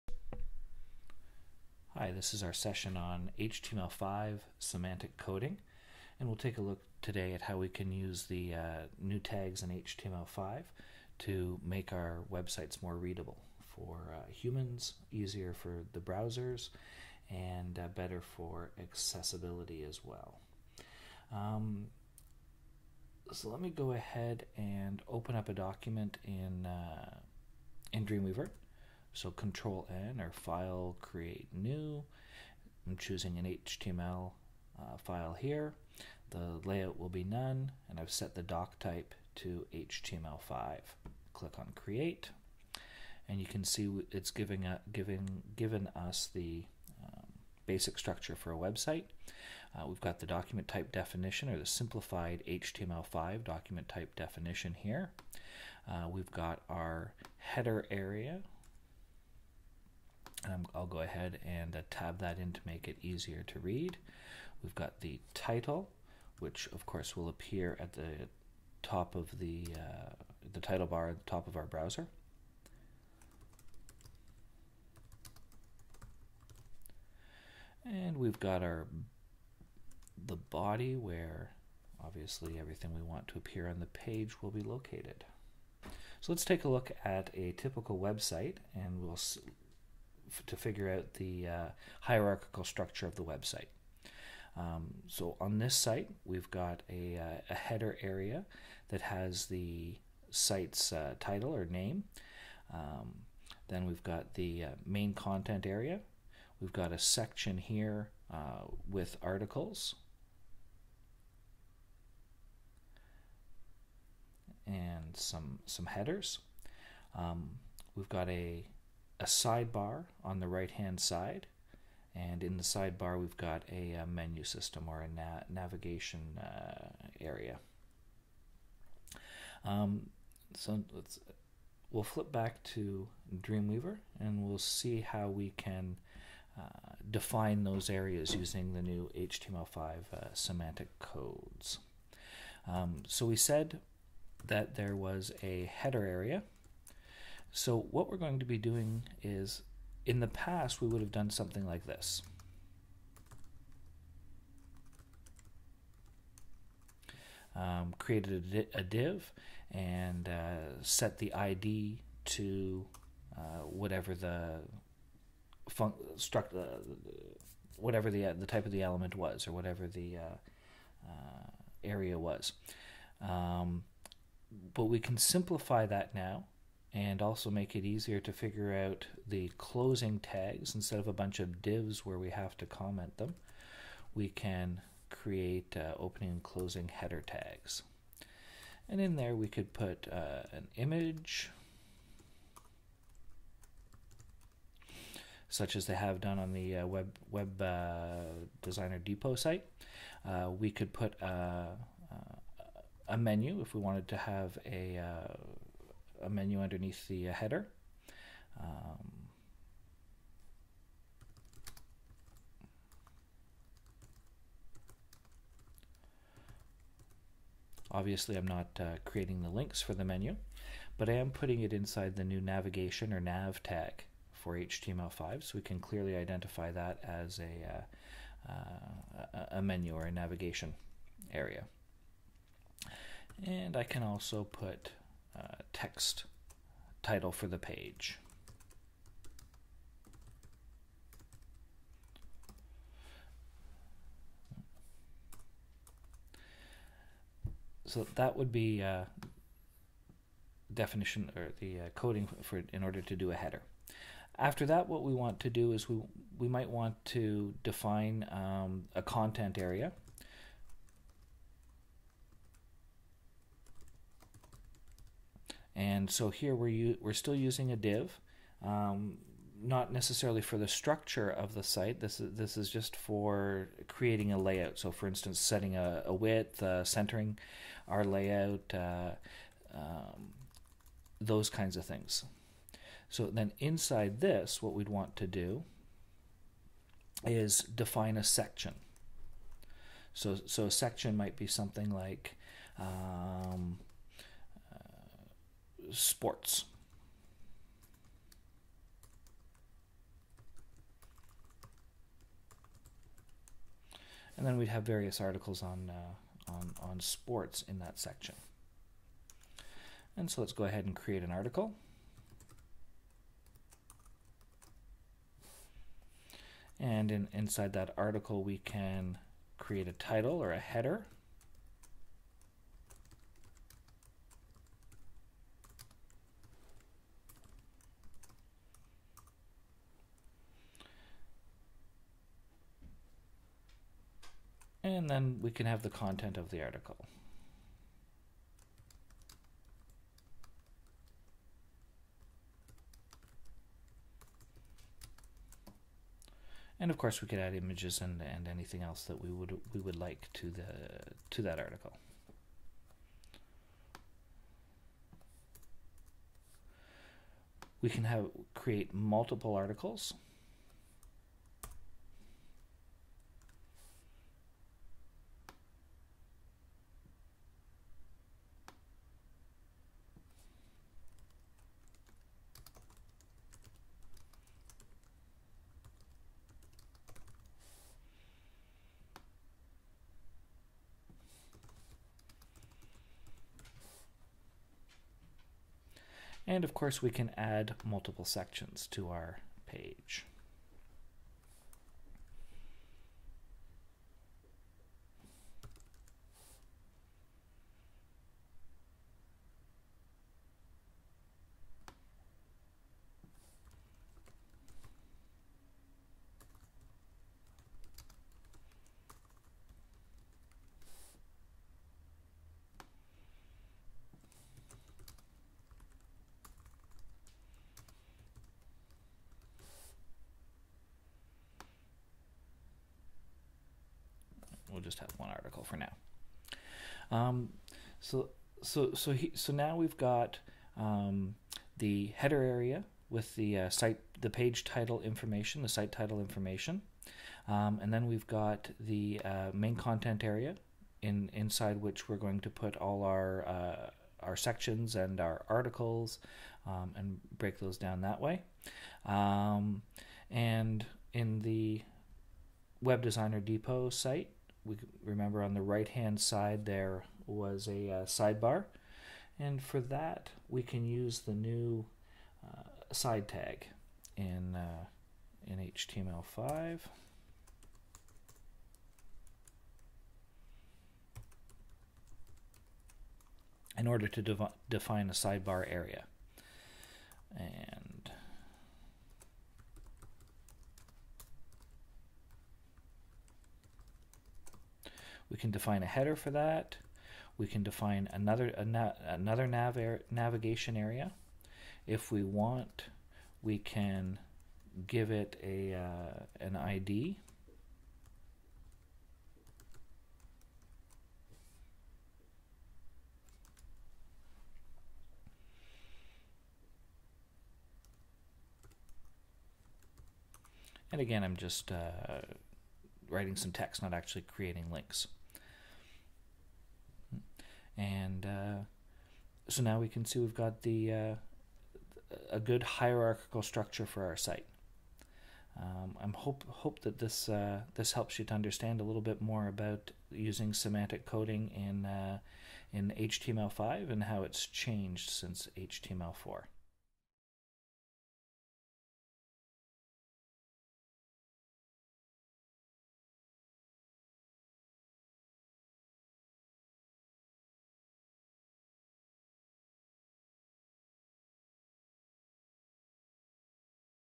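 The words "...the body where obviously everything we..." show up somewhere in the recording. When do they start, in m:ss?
1:20.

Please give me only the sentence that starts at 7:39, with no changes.
And for that, we can use the new uh, side tag in, uh, in HTML5.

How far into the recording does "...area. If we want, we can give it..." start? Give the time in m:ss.
8:10.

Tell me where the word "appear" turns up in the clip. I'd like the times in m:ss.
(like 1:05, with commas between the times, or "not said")
1:07, 1:23.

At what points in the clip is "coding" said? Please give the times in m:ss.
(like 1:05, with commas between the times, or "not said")
0:05, 4:11, 8:51.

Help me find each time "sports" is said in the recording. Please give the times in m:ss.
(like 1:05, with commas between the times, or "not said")
4:55, 5:06.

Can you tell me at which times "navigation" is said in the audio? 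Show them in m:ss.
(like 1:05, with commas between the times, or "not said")
2:05, 3:42, 3:50, 8:10.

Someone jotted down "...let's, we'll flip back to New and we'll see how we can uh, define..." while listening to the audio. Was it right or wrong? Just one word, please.
wrong.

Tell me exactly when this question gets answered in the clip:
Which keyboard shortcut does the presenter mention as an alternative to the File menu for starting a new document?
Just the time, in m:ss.
0:29.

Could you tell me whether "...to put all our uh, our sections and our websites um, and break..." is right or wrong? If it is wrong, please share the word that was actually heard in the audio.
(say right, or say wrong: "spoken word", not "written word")
wrong: "articles", not "websites".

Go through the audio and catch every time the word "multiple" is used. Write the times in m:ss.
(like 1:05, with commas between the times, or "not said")
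5:58, 6:27.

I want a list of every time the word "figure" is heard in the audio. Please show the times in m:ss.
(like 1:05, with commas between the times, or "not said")
1:30, 2:58.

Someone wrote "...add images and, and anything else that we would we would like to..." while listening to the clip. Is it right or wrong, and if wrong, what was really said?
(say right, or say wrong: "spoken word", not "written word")
right.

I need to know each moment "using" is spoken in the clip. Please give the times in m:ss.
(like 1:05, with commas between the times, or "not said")
2:18, 4:27, 8:50.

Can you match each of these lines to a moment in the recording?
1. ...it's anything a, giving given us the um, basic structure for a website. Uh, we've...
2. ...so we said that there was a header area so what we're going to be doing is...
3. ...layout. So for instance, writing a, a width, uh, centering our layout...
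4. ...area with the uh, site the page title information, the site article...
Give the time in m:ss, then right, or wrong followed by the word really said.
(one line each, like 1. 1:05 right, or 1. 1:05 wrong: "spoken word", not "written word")
1. 0:44 wrong: "giving", not "anything"
2. 2:23 right
3. 4:34 wrong: "setting", not "writing"
4. 7:12 wrong: "title", not "article".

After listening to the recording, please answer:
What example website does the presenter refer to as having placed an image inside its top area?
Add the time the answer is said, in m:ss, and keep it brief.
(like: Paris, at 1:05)
Web Designer Depot, at 3:16.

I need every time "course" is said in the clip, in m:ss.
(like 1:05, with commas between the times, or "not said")
1:06, 5:46, 6:26.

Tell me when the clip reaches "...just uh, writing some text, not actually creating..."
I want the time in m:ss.
8:31.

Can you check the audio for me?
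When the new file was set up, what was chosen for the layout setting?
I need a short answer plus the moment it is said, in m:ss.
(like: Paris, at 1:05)
none, at 0:37.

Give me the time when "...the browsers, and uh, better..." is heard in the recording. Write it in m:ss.
0:15.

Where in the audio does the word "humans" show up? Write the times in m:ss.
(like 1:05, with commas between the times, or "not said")
0:14.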